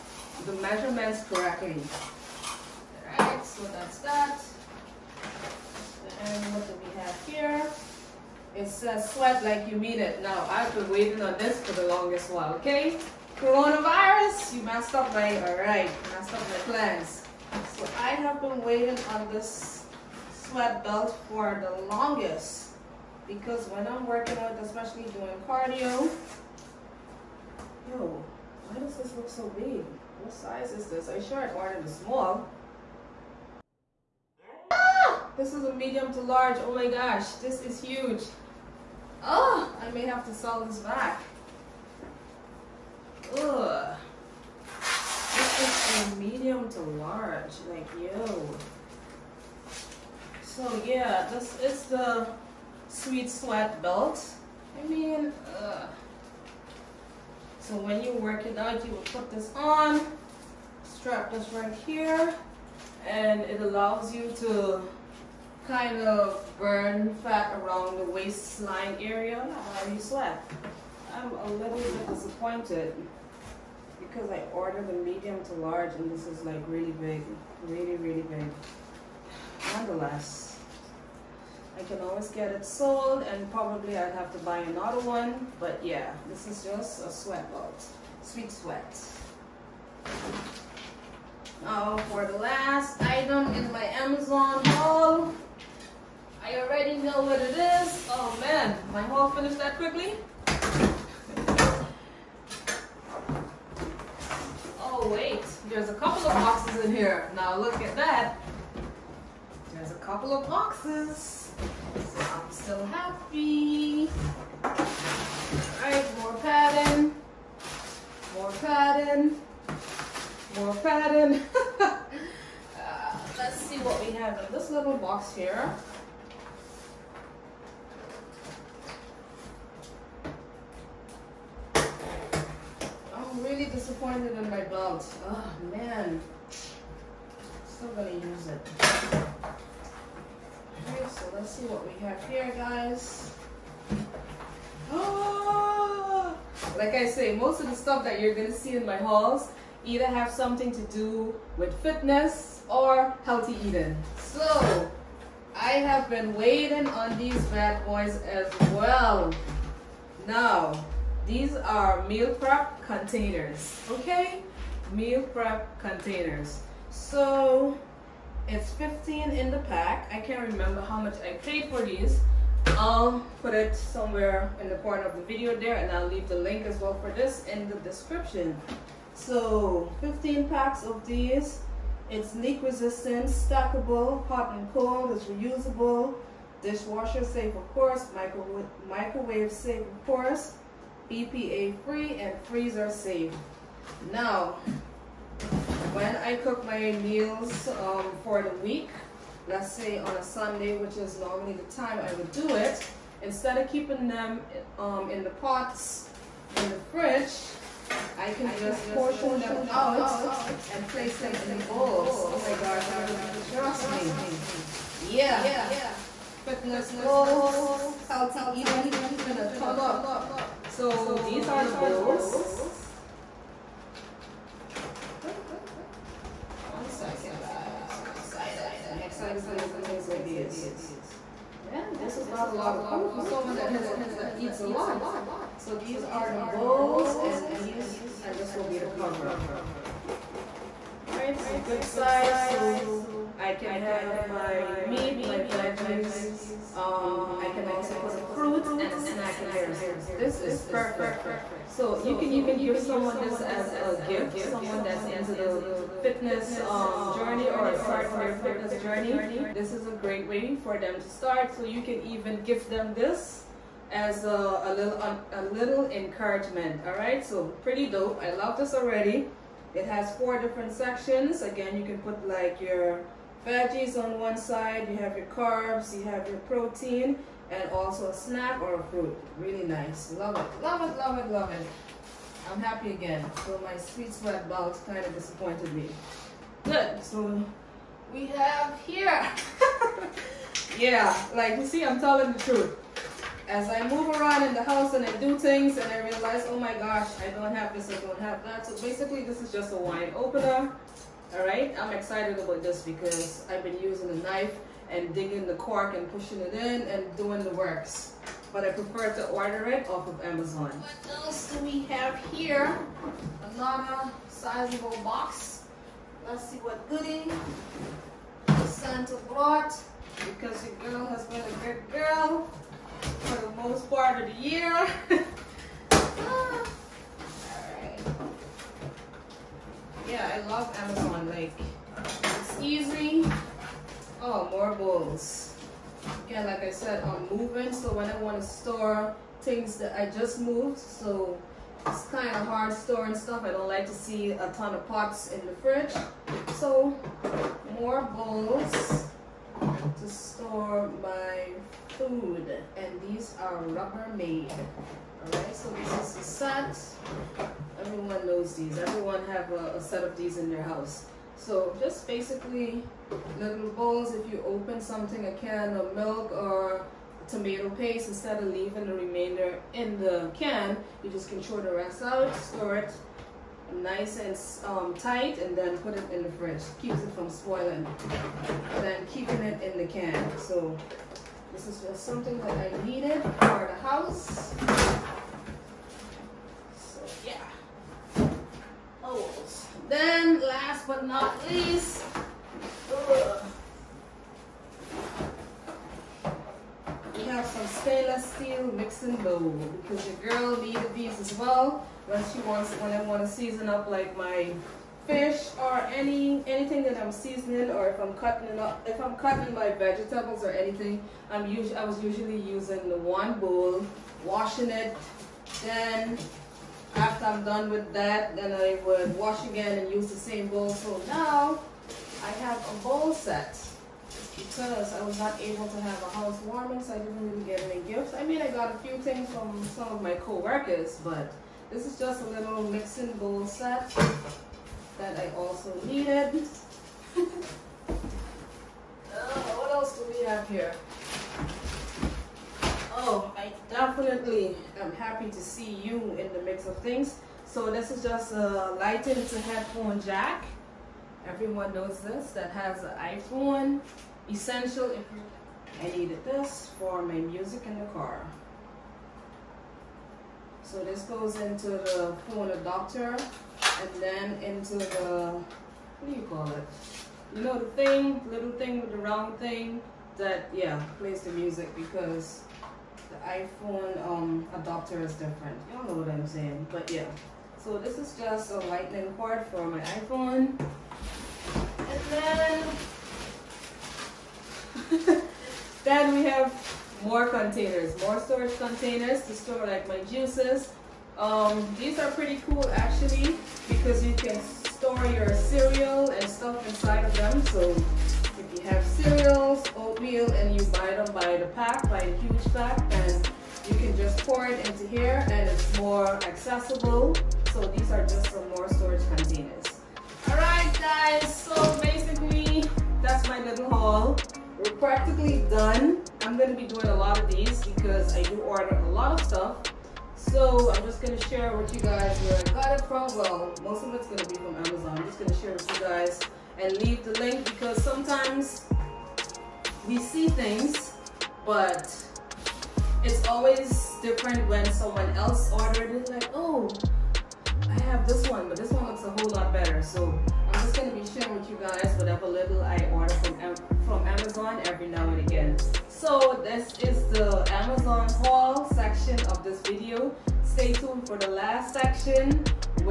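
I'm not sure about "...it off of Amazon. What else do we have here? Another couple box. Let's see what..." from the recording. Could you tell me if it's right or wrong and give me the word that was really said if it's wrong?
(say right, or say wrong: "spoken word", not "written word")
wrong: "sizable", not "couple".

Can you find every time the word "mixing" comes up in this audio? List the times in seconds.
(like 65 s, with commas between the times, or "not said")
398 s, 432 s.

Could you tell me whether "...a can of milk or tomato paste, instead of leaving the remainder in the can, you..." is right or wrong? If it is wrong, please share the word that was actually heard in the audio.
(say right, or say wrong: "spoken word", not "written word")
right.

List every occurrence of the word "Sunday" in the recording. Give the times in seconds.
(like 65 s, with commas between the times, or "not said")
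200 s.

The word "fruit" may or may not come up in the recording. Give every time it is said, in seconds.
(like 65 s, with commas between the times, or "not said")
248 s, 278 s.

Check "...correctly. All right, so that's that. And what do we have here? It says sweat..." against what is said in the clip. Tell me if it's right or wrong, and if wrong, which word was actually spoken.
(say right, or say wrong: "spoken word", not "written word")
right.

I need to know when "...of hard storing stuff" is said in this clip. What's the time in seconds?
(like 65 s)
342 s.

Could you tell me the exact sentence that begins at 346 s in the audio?
So, more bowls to store my food.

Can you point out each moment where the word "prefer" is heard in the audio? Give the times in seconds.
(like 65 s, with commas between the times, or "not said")
308 s.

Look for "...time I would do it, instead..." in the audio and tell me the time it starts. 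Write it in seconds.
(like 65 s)
201 s.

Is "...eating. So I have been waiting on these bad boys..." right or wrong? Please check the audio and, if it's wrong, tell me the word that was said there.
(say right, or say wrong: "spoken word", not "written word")
right.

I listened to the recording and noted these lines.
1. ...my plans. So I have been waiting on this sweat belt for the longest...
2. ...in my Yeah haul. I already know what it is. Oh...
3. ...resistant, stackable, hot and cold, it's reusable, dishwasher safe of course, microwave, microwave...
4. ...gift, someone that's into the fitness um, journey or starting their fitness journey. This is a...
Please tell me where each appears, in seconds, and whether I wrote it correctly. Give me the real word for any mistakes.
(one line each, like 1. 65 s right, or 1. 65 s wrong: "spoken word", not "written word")
1. 16 s right
2. 93 s wrong: "Amazon", not "Yeah"
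3. 182 s right
4. 254 s right.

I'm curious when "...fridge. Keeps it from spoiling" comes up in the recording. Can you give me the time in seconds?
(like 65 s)
376 s.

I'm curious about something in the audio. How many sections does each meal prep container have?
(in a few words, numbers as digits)
4.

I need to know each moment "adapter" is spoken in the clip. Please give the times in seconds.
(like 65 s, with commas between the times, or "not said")
462 s, 474 s.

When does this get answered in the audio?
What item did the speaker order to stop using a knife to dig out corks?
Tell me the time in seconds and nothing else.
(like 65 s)
299 s.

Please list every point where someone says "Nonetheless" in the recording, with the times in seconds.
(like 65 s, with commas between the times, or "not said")
79 s.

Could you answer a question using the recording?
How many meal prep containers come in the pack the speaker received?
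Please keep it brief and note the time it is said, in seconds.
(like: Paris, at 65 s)
15, at 166 s.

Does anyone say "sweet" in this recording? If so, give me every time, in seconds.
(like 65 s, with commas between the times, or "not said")
52 s, 88 s, 283 s.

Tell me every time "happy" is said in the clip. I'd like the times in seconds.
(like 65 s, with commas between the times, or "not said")
112 s, 282 s.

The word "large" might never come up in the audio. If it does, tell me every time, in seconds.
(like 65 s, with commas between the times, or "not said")
36 s, 46 s, 75 s.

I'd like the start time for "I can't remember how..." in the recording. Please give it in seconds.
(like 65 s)
170 s.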